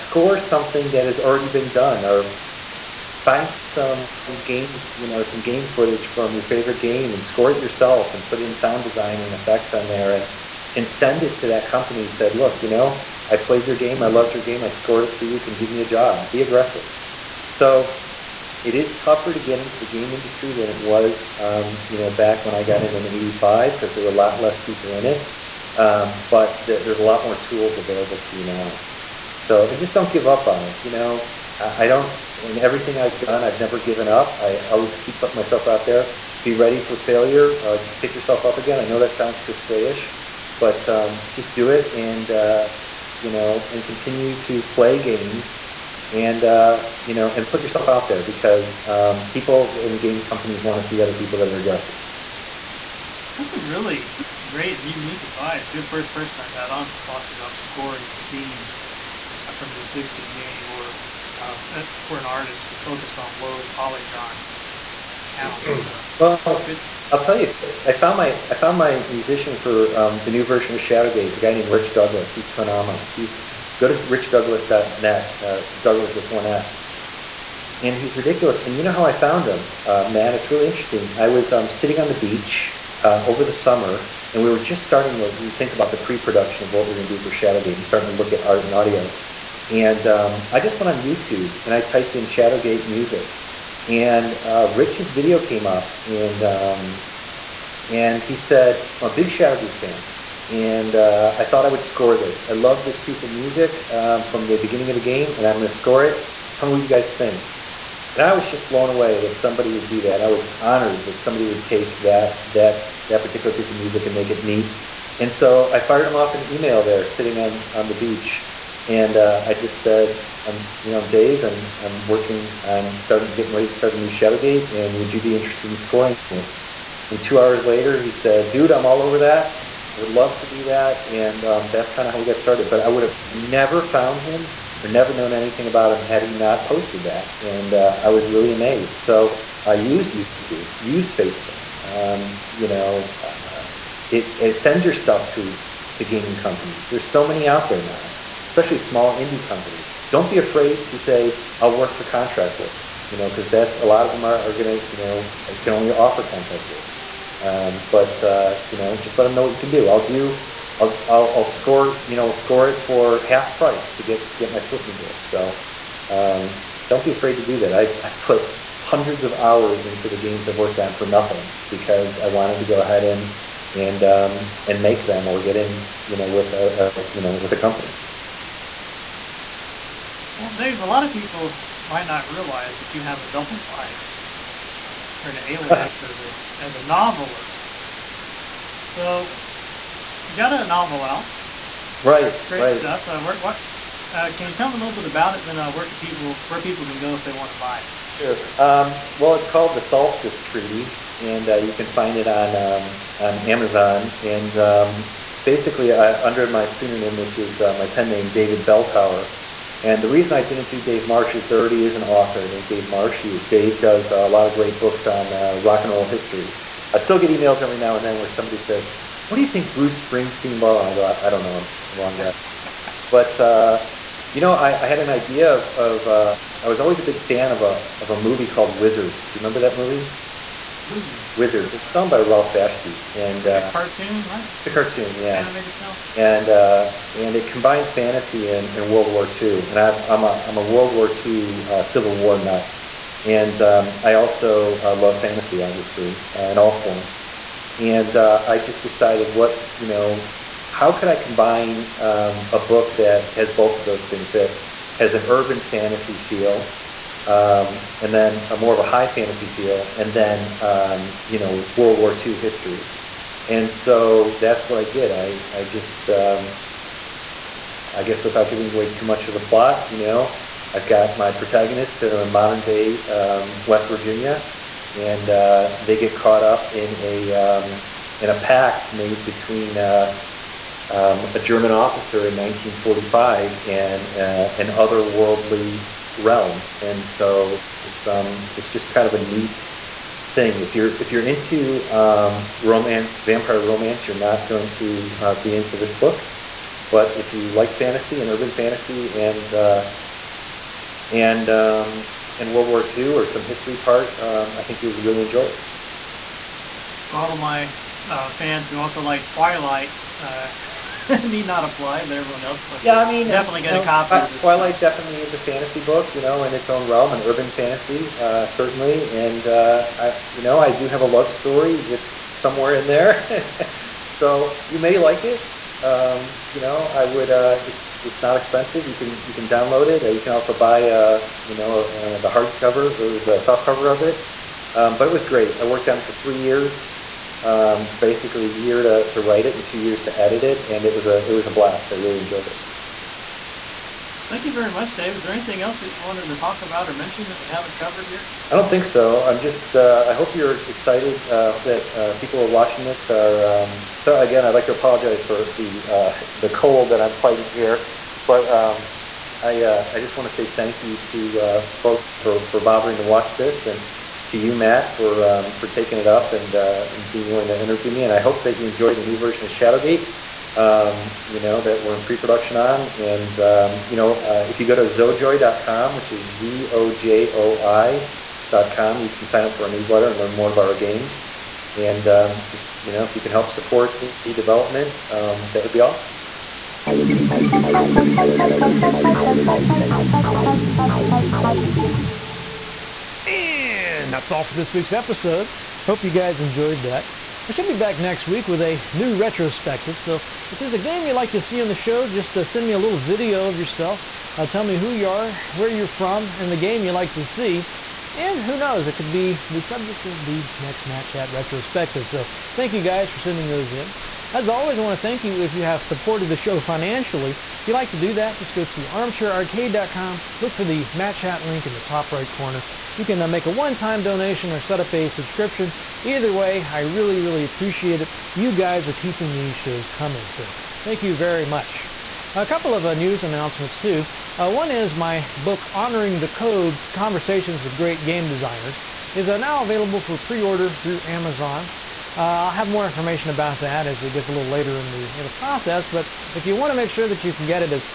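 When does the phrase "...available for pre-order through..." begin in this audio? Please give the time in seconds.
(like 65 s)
439 s.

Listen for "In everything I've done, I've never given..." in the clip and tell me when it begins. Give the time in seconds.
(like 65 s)
32 s.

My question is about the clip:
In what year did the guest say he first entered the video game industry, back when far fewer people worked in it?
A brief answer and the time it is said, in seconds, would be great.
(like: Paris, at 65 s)
1985, at 23 s.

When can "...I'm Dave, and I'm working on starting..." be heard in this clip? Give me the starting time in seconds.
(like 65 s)
121 s.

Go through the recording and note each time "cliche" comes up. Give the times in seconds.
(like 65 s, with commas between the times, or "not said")
39 s.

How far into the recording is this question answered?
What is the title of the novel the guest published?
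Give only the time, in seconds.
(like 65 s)
199 s.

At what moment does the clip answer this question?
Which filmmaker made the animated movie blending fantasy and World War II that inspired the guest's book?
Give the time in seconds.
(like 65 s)
232 s.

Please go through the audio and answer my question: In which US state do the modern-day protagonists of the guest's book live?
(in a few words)
West Virginia.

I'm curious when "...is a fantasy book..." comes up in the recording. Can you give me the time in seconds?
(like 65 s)
315 s.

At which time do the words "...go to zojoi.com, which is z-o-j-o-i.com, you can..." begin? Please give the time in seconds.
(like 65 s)
374 s.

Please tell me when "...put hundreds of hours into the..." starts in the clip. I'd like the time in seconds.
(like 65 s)
168 s.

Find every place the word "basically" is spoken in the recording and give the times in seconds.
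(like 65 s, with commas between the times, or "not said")
205 s, 337 s.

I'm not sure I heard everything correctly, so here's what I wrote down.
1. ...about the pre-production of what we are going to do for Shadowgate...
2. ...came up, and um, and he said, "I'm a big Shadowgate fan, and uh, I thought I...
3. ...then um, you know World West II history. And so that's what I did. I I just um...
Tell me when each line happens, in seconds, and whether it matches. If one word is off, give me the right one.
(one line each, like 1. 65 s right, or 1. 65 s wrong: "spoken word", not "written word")
1. 85 s right
2. 95 s right
3. 260 s wrong: "War", not "West".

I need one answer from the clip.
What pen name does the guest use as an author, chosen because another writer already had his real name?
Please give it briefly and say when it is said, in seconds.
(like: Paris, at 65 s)
David Belltower, at 208 s.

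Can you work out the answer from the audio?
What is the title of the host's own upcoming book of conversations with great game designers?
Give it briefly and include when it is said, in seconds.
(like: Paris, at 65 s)
Honoring the Code, at 435 s.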